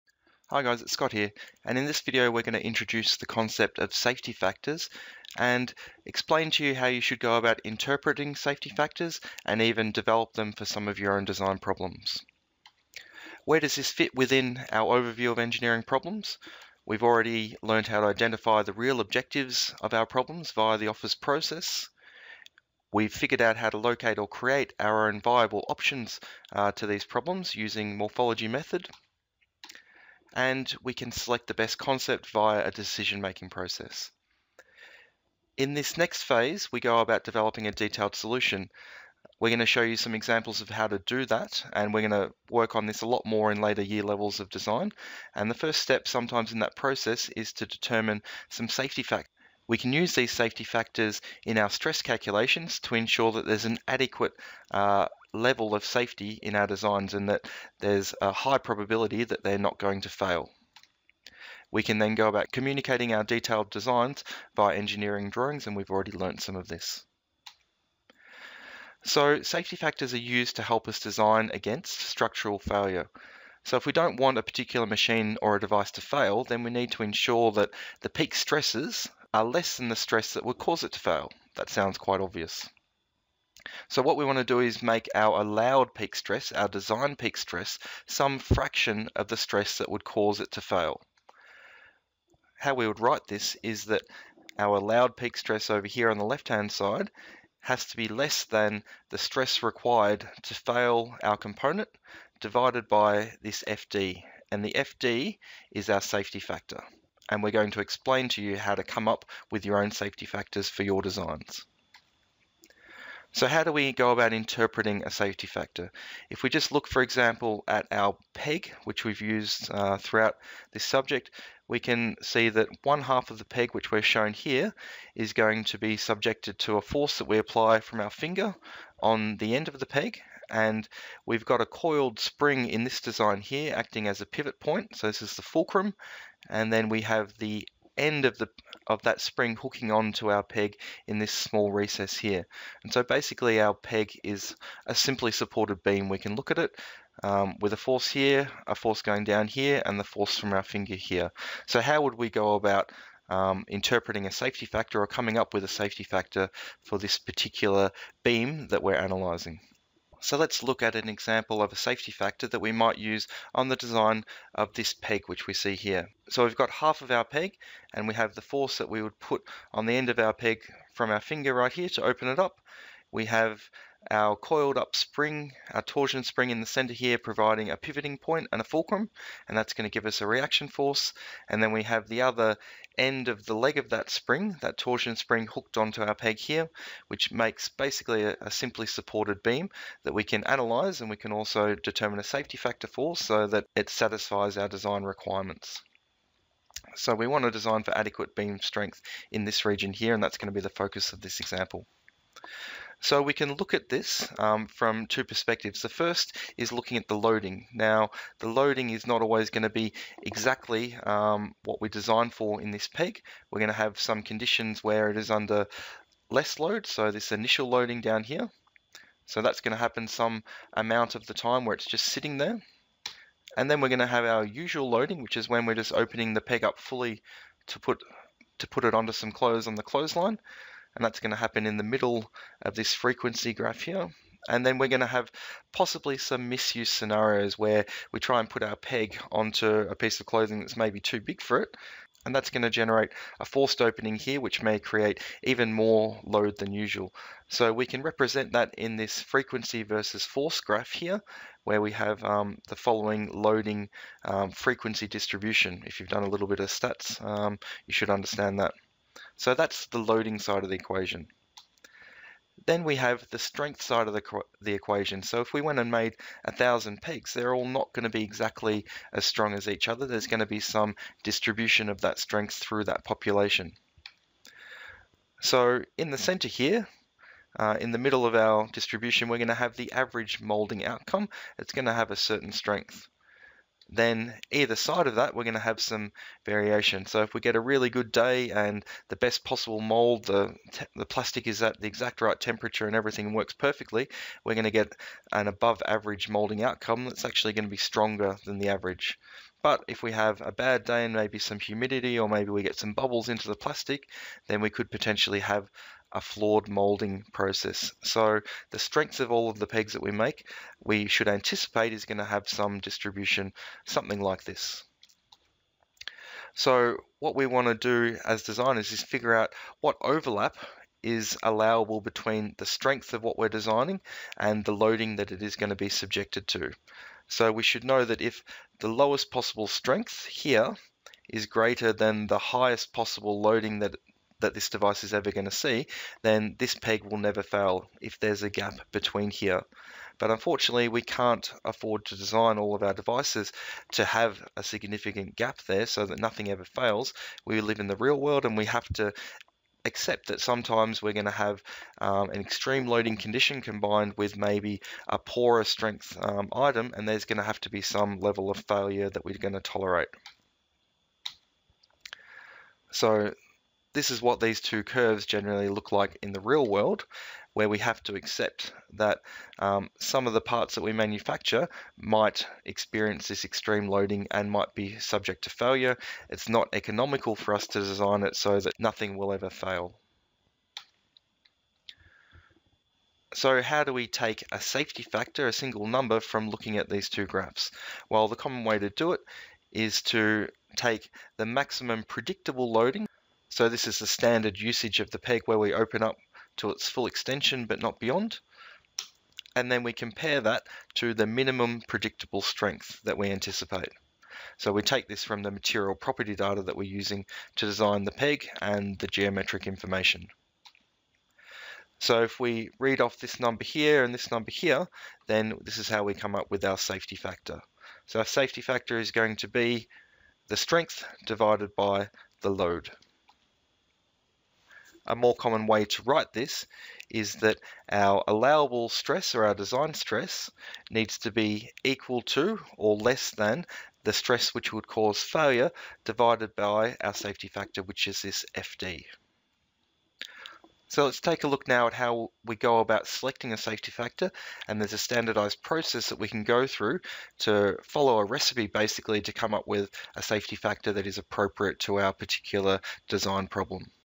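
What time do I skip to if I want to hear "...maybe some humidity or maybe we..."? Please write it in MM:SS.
05:01.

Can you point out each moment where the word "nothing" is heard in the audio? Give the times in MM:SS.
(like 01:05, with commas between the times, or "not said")
05:46, 06:18.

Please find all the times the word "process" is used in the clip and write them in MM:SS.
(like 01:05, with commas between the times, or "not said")
00:21, 00:33, 00:46, 05:07, 07:25.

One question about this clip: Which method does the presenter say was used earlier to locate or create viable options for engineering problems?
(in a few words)
Morphology method.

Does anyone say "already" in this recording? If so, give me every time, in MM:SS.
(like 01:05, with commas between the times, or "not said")
00:17, 01:05.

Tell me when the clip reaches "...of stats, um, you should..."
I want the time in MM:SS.
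04:16.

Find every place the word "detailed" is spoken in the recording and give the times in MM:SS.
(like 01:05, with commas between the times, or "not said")
00:37, 01:03.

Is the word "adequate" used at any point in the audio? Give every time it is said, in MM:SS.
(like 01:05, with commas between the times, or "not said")
00:53, 03:17.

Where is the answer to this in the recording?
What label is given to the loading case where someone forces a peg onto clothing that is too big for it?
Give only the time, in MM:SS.
04:03.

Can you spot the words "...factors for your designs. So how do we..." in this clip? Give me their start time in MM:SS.
01:50.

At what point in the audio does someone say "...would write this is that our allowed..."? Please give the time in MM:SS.
01:32.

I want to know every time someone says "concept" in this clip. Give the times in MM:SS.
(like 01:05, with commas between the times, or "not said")
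00:03, 00:31.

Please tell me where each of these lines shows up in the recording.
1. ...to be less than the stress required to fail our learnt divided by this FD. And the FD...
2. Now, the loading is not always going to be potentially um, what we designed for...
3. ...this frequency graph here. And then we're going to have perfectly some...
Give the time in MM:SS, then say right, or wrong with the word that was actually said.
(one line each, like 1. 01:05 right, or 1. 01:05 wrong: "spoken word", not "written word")
1. 01:37 wrong: "component", not "learnt"
2. 03:27 wrong: "exactly", not "potentially"
3. 03:52 wrong: "possibly", not "perfectly".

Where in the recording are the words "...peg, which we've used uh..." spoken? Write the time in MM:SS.
01:58.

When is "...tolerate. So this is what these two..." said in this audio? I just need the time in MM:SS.
05:59.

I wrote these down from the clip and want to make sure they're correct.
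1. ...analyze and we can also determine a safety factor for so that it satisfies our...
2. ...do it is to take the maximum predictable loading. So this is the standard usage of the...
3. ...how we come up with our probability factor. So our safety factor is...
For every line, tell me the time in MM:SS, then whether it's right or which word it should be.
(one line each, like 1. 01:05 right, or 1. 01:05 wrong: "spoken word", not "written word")
1. 03:10 right
2. 06:28 right
3. 06:55 wrong: "safety", not "probability".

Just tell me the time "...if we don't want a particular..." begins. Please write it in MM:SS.
01:13.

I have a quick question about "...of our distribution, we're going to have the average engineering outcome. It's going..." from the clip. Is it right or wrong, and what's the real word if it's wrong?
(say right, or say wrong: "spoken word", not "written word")
wrong: "molding", not "engineering".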